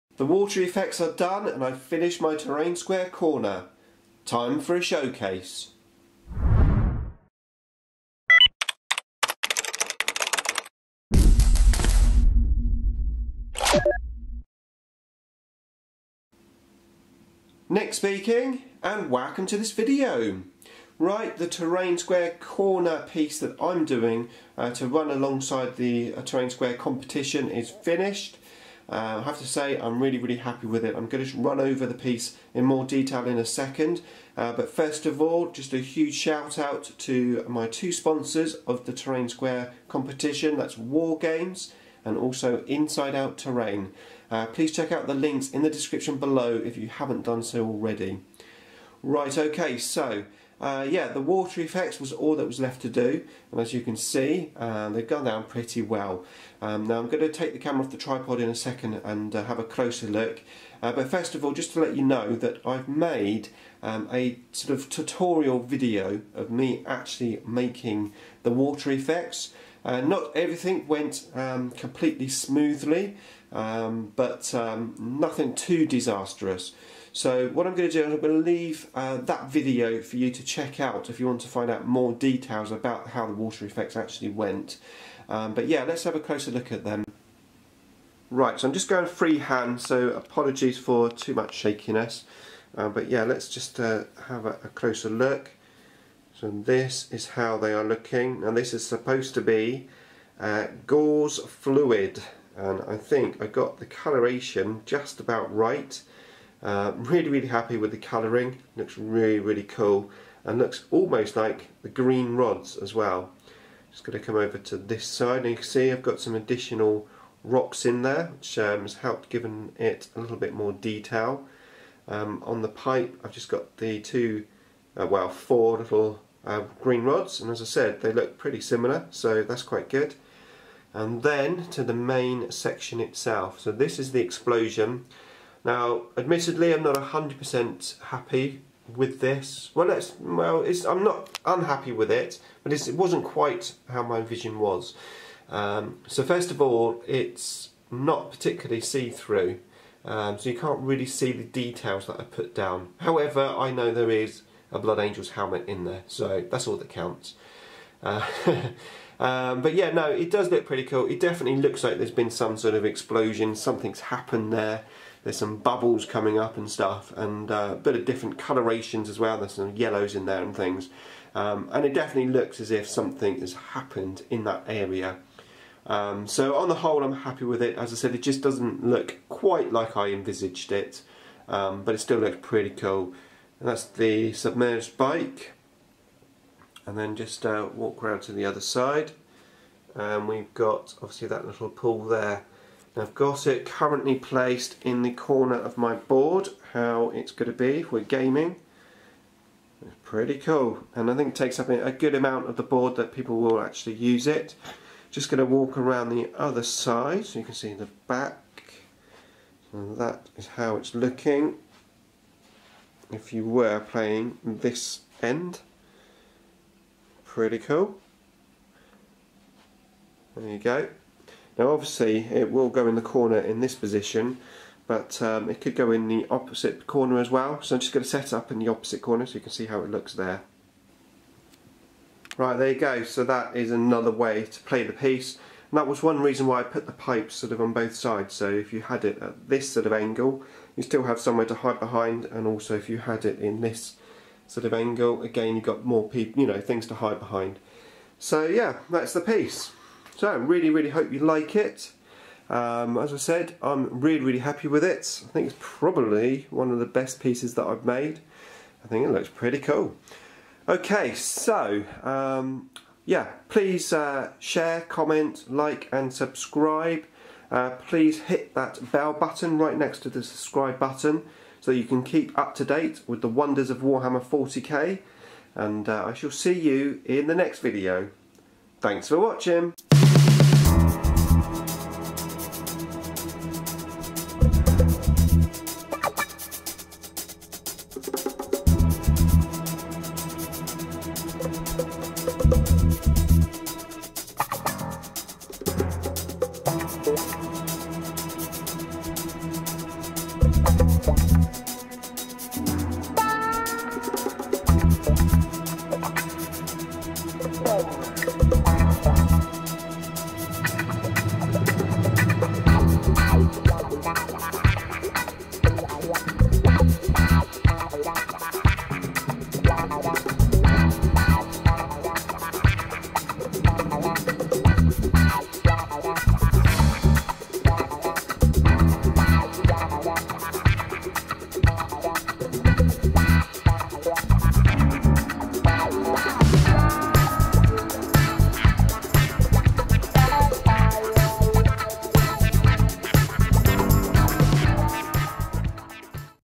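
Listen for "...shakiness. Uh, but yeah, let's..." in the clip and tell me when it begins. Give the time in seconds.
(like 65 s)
91 s.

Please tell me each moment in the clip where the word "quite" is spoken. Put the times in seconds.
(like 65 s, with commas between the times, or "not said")
129 s, 143 s, 179 s.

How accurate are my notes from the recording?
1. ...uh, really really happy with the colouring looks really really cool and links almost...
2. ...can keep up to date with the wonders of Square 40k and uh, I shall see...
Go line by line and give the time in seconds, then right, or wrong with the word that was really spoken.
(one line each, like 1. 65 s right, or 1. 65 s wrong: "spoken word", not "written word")
1. 106 s wrong: "looks", not "links"
2. 271 s wrong: "Warhammer", not "Square".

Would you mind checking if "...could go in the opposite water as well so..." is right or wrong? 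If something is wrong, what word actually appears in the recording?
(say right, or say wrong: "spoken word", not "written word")
wrong: "corner", not "water".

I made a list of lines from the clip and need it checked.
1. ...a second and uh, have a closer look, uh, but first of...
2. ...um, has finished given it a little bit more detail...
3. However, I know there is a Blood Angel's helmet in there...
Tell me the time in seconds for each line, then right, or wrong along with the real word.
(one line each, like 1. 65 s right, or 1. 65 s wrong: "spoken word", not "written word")
1. 58 s right
2. 118 s wrong: "helped", not "finished"
3. 152 s right.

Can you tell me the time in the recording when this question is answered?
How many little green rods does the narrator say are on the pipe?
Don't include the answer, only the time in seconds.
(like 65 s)
125 s.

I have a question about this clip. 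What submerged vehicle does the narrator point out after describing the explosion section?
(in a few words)
bike.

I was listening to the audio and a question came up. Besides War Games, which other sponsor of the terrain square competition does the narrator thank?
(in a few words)
Inside Out Terrain.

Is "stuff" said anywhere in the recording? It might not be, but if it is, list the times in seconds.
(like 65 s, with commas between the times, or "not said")
166 s.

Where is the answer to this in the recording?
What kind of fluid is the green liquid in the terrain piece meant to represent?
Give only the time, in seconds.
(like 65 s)
100 s.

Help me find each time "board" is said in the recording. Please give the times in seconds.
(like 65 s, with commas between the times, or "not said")
195 s, 202 s.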